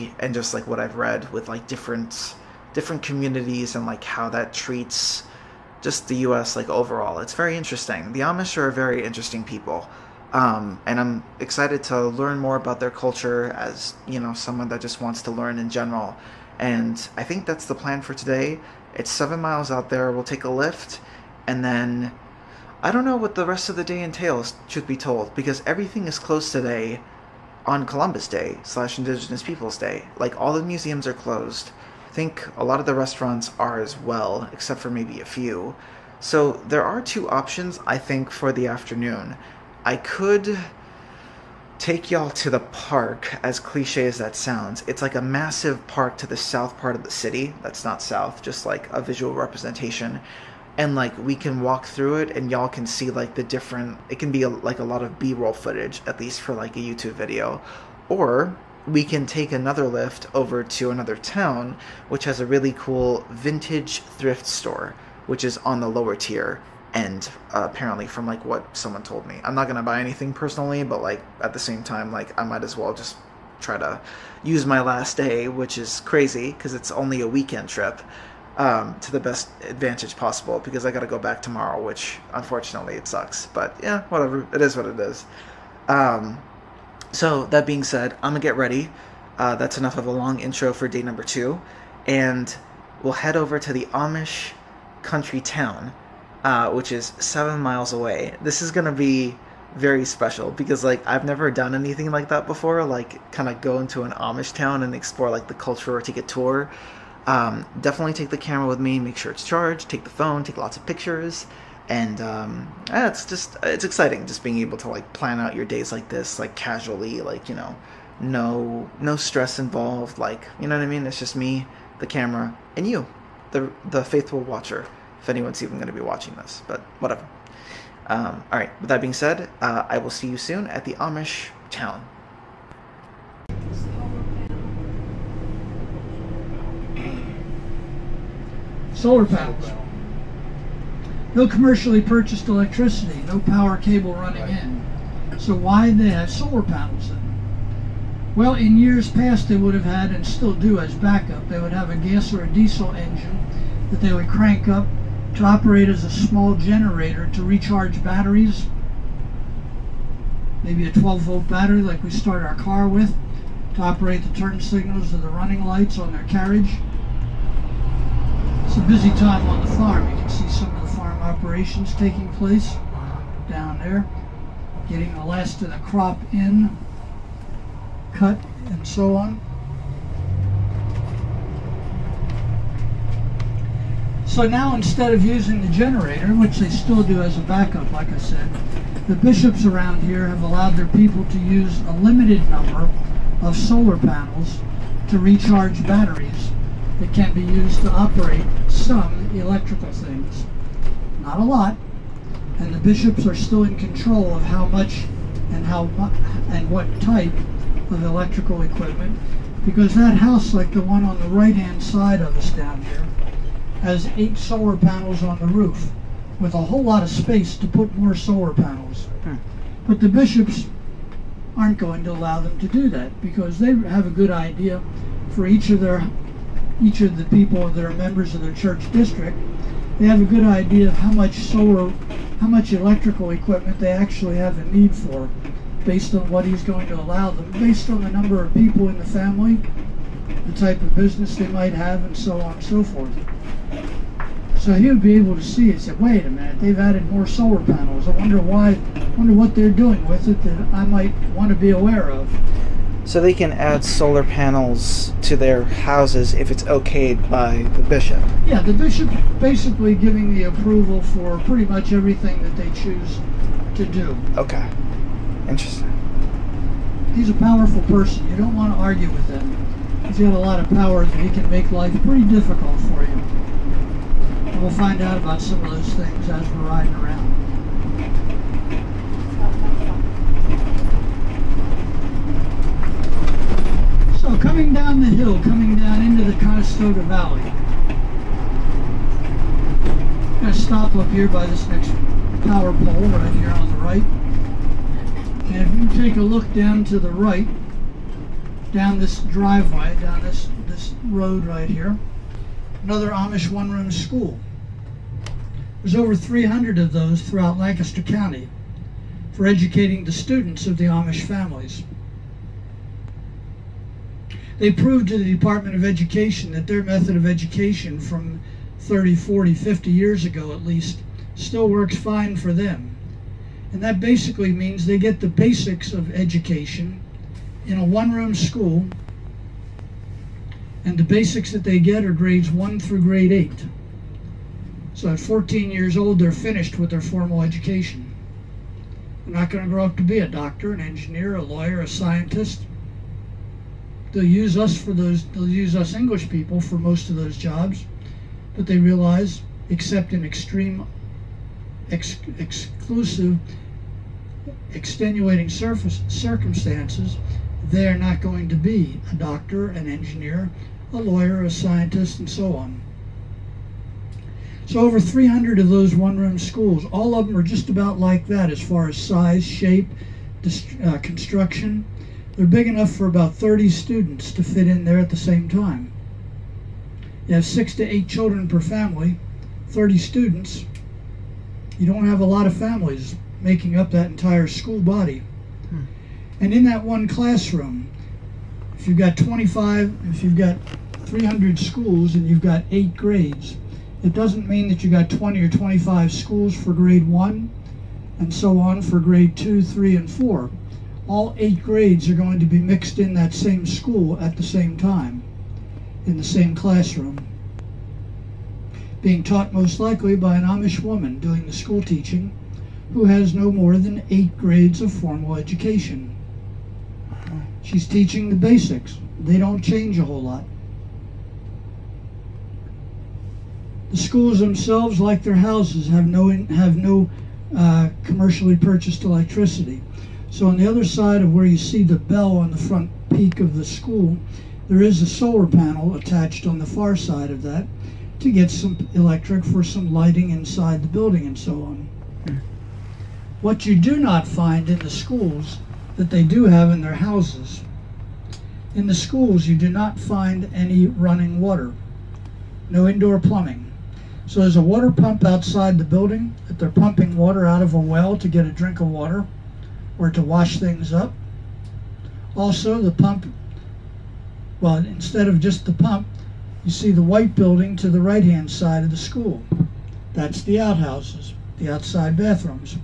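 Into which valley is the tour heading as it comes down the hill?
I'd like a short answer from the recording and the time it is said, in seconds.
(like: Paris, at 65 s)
Conestoga Valley, at 286 s.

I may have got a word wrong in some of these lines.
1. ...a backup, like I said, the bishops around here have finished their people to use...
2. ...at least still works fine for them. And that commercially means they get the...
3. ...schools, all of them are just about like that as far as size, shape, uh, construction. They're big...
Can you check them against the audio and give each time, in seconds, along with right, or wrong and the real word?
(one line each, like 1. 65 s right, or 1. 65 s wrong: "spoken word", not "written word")
1. 187 s wrong: "allowed", not "finished"
2. 320 s wrong: "basically", not "commercially"
3. 366 s right.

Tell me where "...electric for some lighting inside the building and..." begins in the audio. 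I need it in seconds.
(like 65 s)
438 s.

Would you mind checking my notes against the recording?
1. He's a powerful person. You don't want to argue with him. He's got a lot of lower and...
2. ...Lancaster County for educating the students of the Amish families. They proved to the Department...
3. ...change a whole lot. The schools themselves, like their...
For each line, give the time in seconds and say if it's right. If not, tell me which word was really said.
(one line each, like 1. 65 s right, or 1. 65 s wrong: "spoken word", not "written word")
1. 267 s wrong: "power", not "lower"
2. 307 s right
3. 419 s right.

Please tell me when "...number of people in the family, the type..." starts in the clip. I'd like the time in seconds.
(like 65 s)
238 s.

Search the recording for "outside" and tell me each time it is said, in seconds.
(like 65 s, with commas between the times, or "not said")
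455 s, 471 s.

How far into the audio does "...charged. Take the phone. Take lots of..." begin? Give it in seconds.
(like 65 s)
109 s.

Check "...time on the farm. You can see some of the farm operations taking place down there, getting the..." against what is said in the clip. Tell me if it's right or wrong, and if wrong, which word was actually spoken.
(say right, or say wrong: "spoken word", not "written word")
right.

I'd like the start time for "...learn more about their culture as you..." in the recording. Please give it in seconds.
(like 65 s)
12 s.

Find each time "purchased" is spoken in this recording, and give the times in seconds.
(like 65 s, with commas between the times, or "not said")
142 s, 428 s.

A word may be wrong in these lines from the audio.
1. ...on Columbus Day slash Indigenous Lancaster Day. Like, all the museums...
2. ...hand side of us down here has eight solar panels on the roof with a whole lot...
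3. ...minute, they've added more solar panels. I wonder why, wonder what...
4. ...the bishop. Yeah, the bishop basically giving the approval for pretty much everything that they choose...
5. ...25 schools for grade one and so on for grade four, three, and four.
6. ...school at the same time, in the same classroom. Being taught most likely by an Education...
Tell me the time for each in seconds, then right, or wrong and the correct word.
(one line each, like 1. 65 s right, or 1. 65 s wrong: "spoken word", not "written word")
1. 27 s wrong: "Peoples", not "Lancaster"
2. 211 s right
3. 246 s right
4. 257 s right
5. 395 s wrong: "two", not "four"
6. 403 s wrong: "Amish", not "Education".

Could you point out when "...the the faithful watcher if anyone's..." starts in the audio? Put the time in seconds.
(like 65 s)
123 s.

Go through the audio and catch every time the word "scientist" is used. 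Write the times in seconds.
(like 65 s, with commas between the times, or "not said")
341 s, 361 s.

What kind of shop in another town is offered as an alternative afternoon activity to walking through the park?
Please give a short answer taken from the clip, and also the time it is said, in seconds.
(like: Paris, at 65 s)
vintage thrift store, at 63 s.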